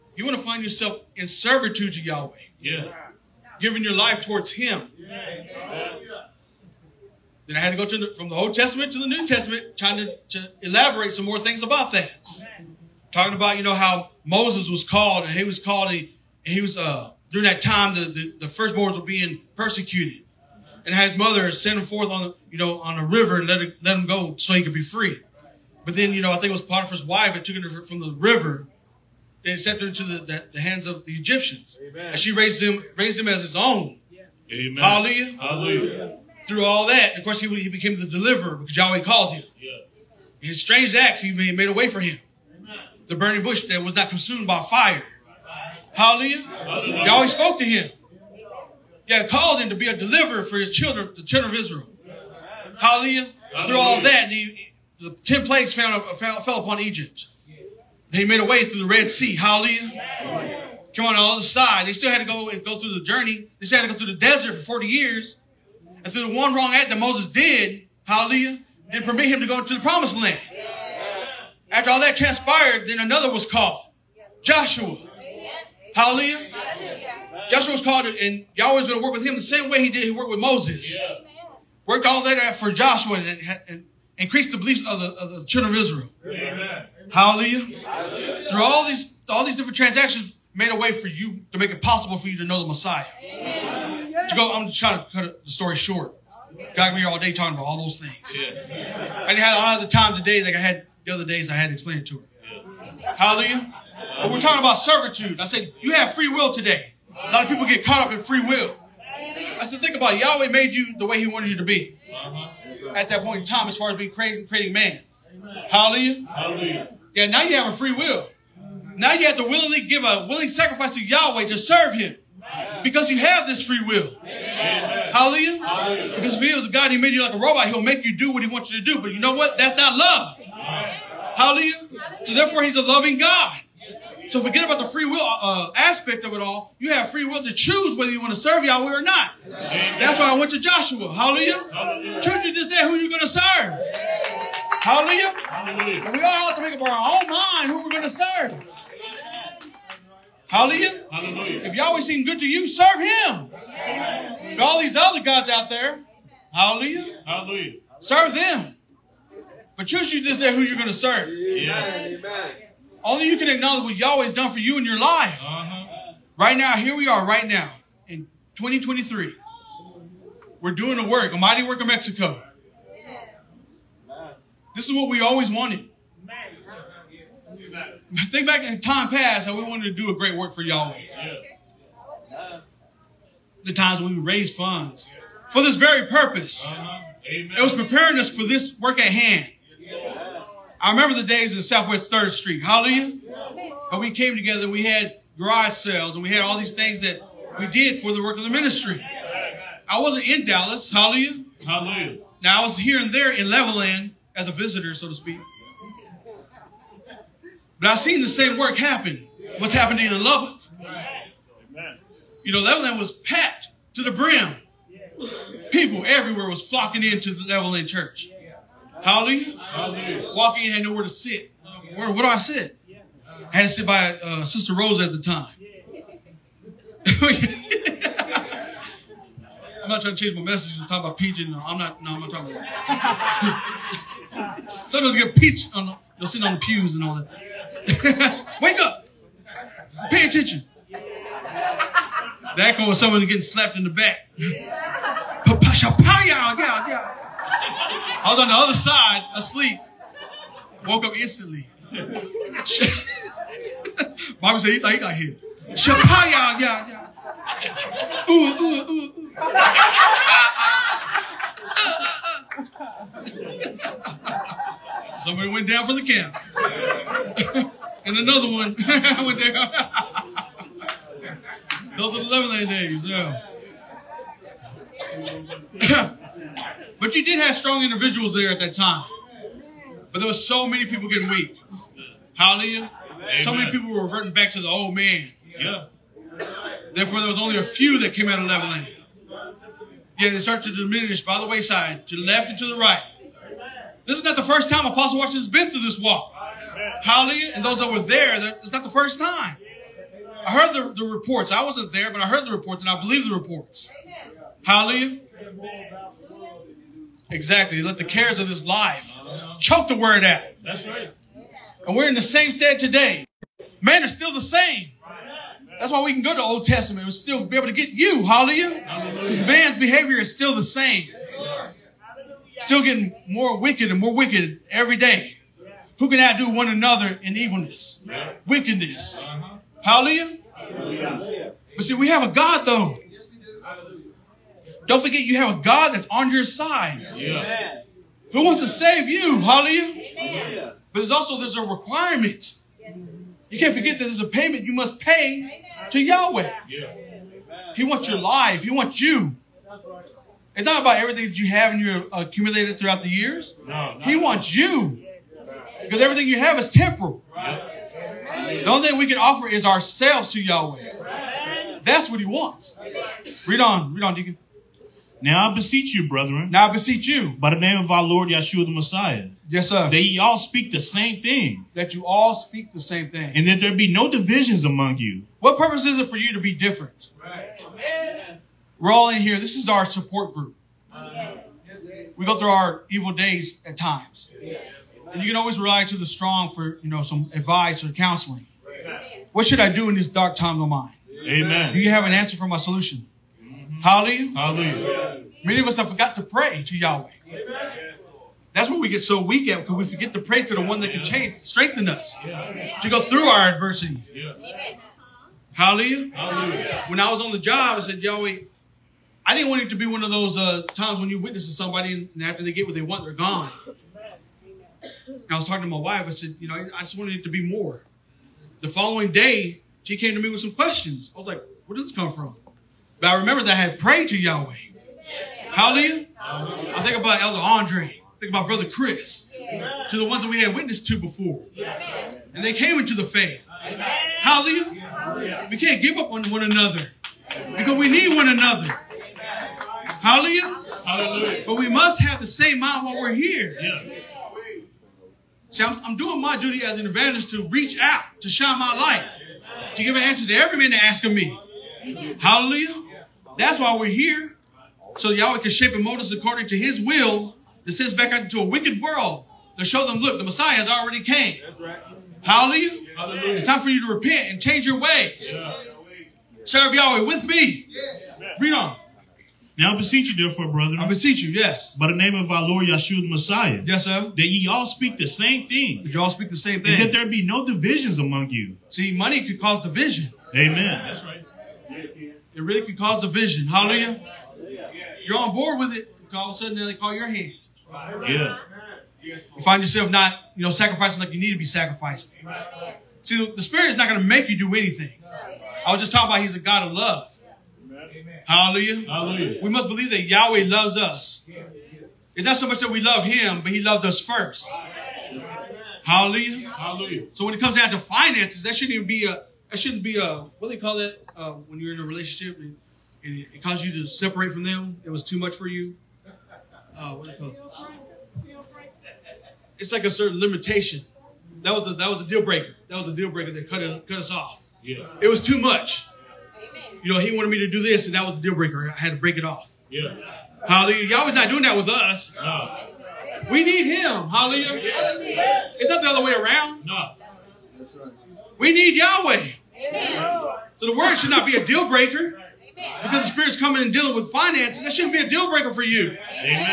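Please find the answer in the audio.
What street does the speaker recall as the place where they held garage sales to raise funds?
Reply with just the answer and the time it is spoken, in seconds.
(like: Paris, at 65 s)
Southwest 3rd Street, at 191 s.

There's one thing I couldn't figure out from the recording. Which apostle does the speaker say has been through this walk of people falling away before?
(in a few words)
Apostle Washington.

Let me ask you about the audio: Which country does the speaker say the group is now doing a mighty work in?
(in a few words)
Mexico.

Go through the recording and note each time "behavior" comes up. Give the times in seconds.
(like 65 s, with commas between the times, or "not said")
319 s.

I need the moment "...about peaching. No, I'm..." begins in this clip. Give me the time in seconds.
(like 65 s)
230 s.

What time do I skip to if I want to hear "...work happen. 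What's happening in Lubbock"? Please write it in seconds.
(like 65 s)
208 s.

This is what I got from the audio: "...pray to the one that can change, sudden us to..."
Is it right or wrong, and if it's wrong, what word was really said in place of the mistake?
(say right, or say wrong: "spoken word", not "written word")
wrong: "strengthen", not "sudden".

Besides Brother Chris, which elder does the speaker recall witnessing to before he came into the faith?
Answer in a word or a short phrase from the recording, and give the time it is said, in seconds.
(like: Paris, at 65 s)
Elder Andre, at 427 s.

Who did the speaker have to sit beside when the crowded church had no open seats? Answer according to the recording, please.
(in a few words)
Sister Rose.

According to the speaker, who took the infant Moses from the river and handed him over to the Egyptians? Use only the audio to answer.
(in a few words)
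Potiphar's wife.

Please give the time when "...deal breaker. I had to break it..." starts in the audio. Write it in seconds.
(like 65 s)
528 s.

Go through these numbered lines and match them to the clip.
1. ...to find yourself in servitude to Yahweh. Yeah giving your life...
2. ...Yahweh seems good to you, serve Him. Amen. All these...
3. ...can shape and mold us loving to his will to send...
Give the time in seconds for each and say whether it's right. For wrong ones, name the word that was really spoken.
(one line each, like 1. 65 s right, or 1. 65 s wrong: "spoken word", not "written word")
1. 0 s right
2. 151 s right
3. 455 s wrong: "according", not "loving".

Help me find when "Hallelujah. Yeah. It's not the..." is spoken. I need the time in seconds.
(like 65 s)
534 s.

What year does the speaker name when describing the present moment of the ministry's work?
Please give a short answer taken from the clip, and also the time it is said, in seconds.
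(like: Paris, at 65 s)
2023, at 168 s.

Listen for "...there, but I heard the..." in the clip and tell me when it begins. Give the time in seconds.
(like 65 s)
301 s.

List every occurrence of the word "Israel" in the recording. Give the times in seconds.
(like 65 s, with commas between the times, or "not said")
51 s, 85 s.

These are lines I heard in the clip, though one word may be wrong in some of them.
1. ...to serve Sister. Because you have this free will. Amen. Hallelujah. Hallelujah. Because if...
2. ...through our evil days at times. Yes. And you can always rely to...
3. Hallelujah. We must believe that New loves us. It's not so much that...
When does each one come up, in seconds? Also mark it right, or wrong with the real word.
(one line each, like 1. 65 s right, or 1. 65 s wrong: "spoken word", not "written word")
1. 121 s wrong: "Him", not "Sister"
2. 382 s right
3. 498 s wrong: "Yahweh", not "New".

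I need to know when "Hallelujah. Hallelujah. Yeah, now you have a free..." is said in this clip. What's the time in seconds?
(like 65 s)
115 s.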